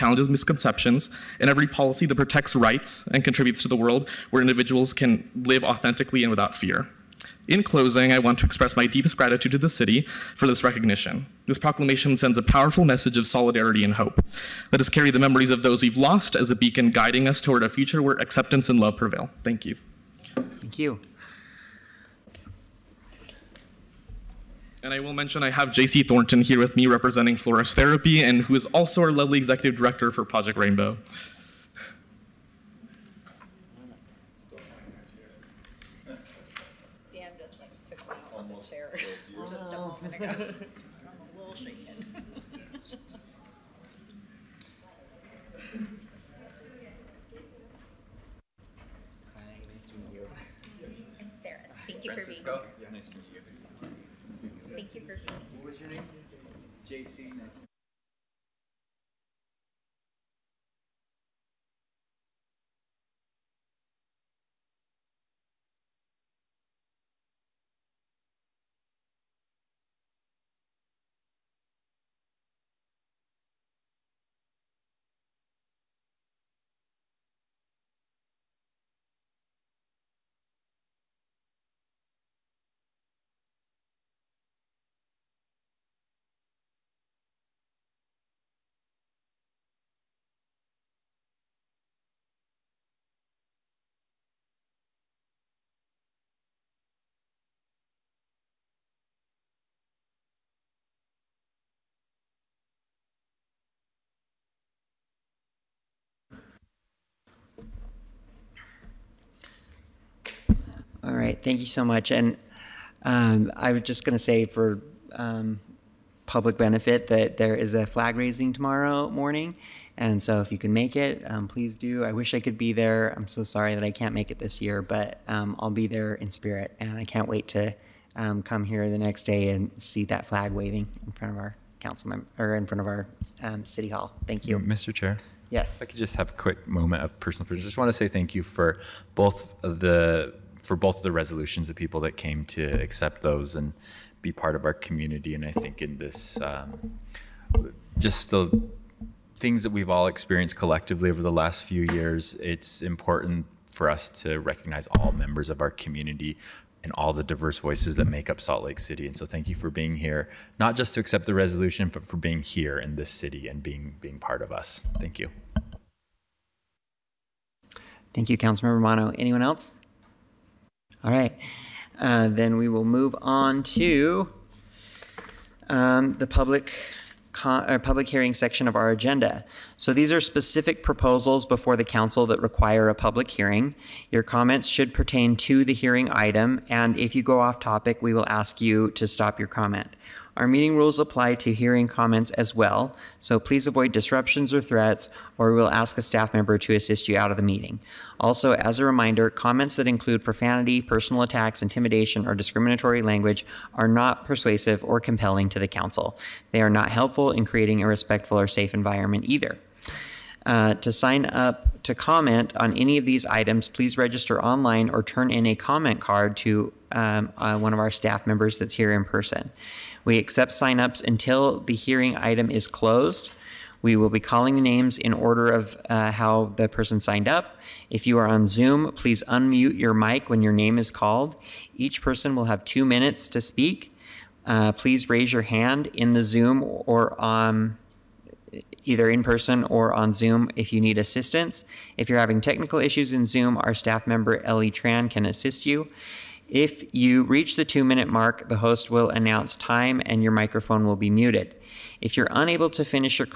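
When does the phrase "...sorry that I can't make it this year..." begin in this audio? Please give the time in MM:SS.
02:03.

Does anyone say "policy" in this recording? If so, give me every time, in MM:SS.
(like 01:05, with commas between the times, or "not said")
00:01.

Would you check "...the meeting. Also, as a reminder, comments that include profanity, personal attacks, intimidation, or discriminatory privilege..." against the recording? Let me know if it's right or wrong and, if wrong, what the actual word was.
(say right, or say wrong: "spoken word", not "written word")
wrong: "language", not "privilege".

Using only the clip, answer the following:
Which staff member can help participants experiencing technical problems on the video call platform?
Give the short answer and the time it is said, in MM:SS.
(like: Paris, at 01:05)
Ellie Tran, at 04:04.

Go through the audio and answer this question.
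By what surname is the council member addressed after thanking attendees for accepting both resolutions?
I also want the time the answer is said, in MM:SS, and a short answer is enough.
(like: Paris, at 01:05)
Romano, at 02:48.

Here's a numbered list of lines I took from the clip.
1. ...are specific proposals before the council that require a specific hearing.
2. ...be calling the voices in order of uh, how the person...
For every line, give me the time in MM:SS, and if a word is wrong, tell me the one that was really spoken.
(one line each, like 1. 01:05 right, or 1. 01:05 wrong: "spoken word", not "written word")
1. 03:00 wrong: "public", not "specific"
2. 03:44 wrong: "names", not "voices".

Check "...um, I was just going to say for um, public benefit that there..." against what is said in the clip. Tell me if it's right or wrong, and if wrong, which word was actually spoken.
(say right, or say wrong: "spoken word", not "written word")
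right.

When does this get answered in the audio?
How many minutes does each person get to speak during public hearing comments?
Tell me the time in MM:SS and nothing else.
03:52.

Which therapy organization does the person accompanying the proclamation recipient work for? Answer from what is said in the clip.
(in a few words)
Flourish Therapy.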